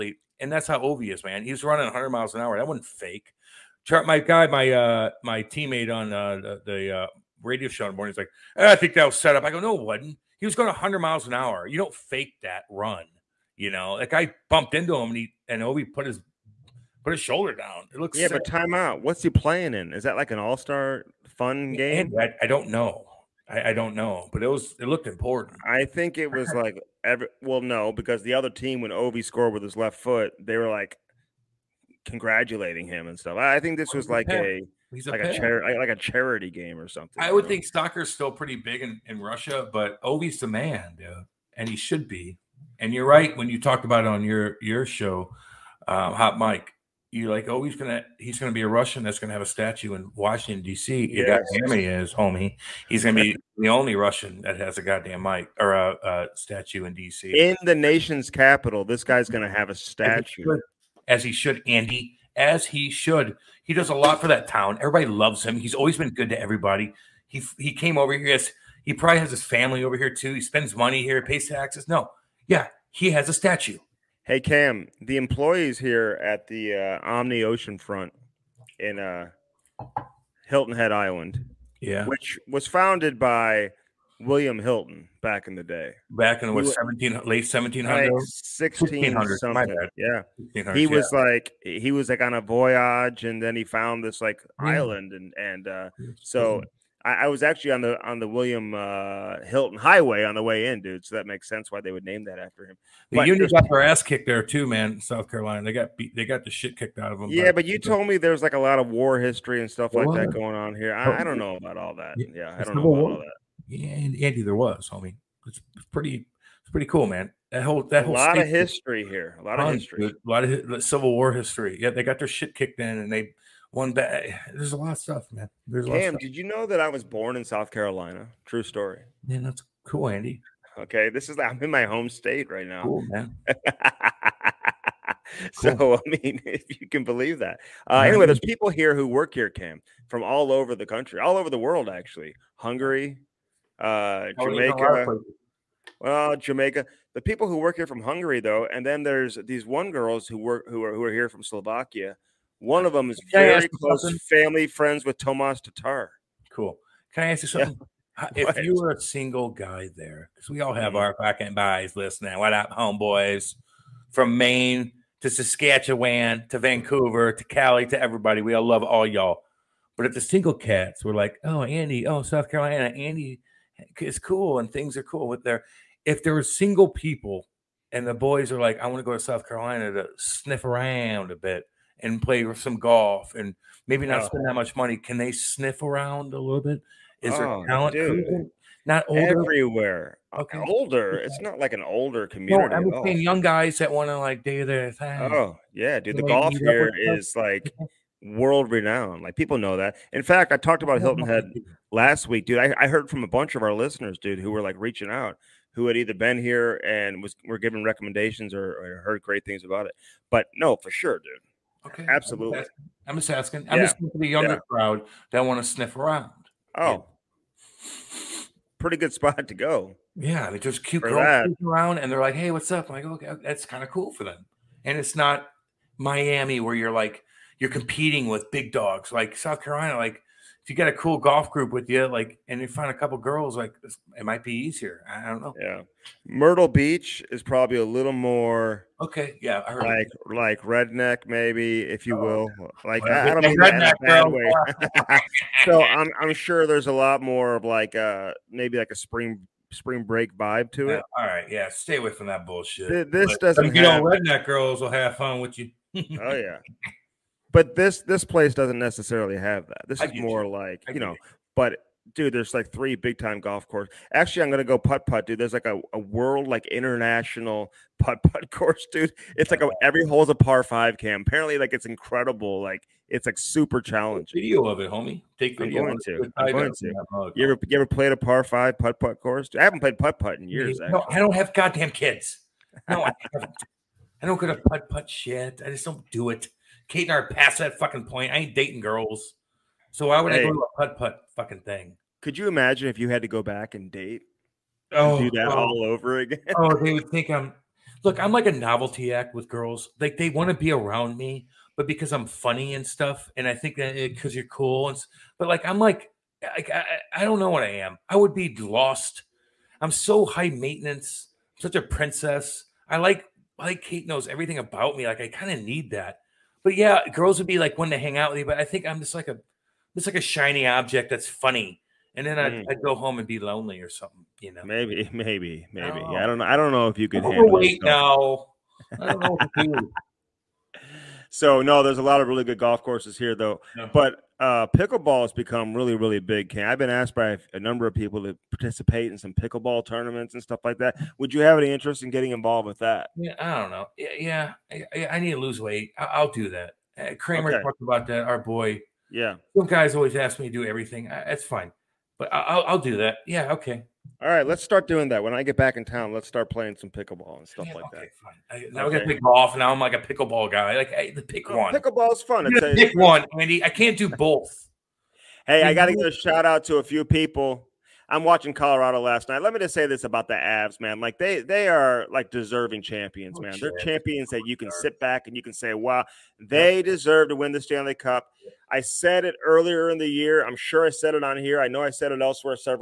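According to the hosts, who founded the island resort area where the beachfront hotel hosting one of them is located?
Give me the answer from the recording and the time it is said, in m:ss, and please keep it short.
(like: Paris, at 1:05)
William Hilton, at 1:24.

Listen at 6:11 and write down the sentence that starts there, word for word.
Like they they are like deserving champions, oh, man.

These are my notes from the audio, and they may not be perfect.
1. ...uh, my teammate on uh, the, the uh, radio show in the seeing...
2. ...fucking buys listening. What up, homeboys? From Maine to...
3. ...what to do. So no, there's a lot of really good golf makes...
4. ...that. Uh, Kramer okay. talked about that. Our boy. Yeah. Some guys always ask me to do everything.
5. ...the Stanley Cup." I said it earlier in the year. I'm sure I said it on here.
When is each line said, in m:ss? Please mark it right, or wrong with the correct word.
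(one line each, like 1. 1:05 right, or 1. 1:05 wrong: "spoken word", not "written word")
1. 0:04 wrong: "morning", not "seeing"
2. 2:41 right
3. 5:29 wrong: "courses", not "makes"
4. 5:46 right
5. 6:17 right.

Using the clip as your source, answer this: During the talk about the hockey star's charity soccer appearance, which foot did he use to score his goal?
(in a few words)
Left foot.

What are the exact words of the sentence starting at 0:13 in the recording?
You know, like I bumped into him and he and Ovi put his put his shoulder down.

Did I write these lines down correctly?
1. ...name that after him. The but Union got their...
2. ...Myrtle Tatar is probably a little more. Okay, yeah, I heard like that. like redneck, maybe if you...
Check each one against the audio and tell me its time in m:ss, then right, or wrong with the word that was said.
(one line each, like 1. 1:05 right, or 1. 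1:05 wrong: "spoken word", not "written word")
1. 1:42 right
2. 3:56 wrong: "Beach", not "Tatar".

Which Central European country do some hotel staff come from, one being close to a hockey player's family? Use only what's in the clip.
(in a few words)
Slovakia.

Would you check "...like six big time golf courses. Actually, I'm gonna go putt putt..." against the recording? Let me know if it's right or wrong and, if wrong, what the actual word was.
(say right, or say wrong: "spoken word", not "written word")
wrong: "three", not "six".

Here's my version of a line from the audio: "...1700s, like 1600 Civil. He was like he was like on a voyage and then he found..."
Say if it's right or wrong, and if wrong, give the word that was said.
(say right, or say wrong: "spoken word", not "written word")
wrong: "Yeah", not "Civil".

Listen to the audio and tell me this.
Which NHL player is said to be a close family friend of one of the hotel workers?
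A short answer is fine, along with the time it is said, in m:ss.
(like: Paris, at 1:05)
Tomas Tatar, at 2:35.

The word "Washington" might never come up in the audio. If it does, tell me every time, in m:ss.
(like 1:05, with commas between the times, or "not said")
0:50.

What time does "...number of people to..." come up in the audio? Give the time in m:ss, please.
5:37.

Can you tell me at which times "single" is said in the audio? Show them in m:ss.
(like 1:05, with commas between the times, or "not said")
2:39, 2:50, 2:56.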